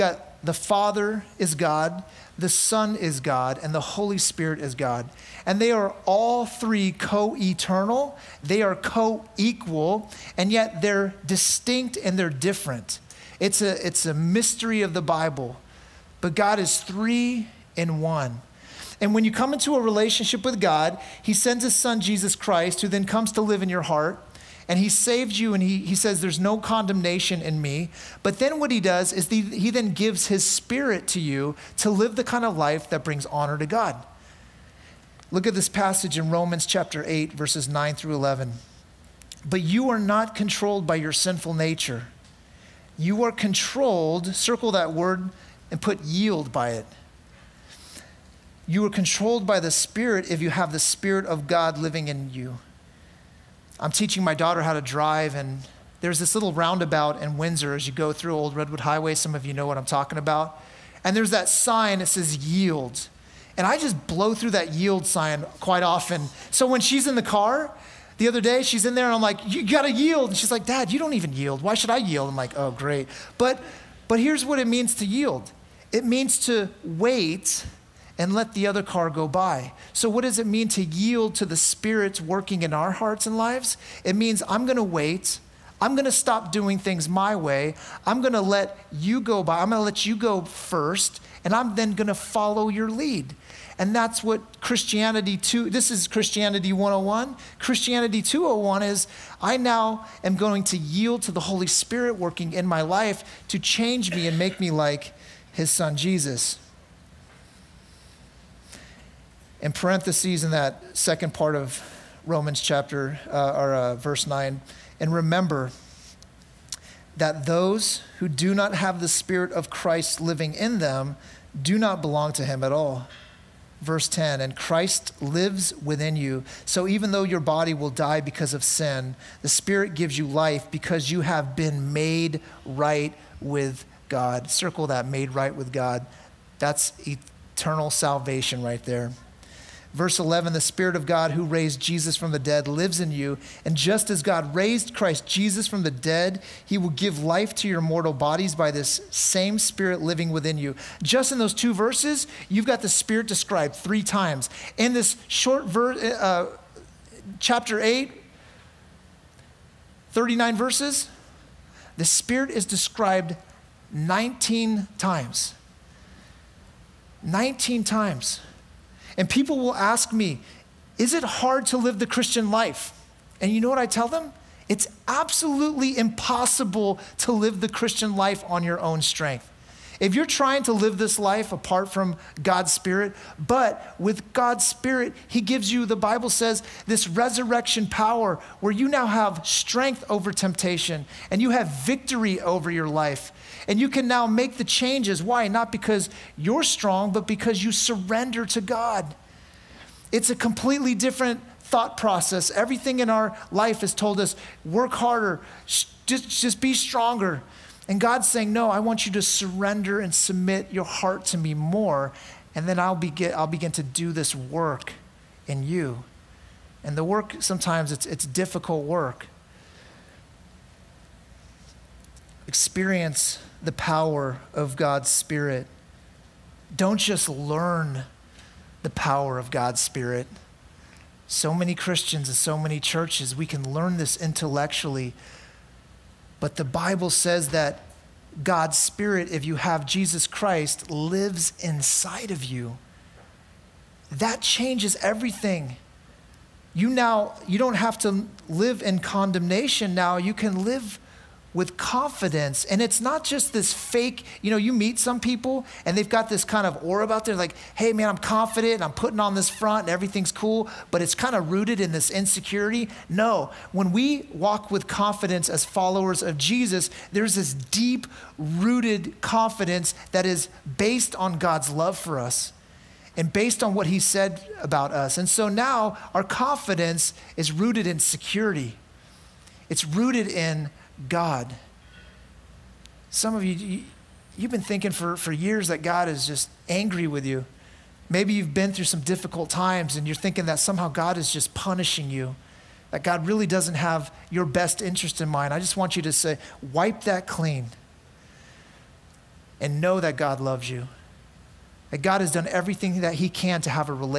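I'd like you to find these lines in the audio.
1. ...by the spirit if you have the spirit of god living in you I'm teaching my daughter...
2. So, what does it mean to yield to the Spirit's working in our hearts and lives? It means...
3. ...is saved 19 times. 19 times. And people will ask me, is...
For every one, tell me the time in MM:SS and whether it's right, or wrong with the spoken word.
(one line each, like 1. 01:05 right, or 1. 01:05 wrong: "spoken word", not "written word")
1. 00:49 right
2. 01:19 right
3. 02:42 wrong: "described", not "saved".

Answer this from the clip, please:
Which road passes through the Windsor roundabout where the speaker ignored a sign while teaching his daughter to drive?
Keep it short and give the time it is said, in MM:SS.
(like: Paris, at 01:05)
Old Redwood Highway, at 00:58.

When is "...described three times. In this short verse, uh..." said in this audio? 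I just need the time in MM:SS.
02:33.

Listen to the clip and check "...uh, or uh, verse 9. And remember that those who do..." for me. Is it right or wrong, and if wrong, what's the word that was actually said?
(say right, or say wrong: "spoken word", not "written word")
right.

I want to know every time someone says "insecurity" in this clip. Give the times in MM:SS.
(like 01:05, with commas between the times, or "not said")
04:22.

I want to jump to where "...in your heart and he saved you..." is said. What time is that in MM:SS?
00:23.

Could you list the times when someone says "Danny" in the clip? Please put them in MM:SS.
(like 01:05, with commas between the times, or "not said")
not said.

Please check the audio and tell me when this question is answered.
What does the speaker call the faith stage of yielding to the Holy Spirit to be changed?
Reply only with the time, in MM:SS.
01:37.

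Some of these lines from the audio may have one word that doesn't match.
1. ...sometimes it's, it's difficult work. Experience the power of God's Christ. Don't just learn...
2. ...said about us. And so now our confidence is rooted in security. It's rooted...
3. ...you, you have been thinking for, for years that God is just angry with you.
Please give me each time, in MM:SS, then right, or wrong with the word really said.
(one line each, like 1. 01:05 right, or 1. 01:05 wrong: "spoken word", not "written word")
1. 03:37 wrong: "Spirit", not "Christ"
2. 04:33 right
3. 04:43 right.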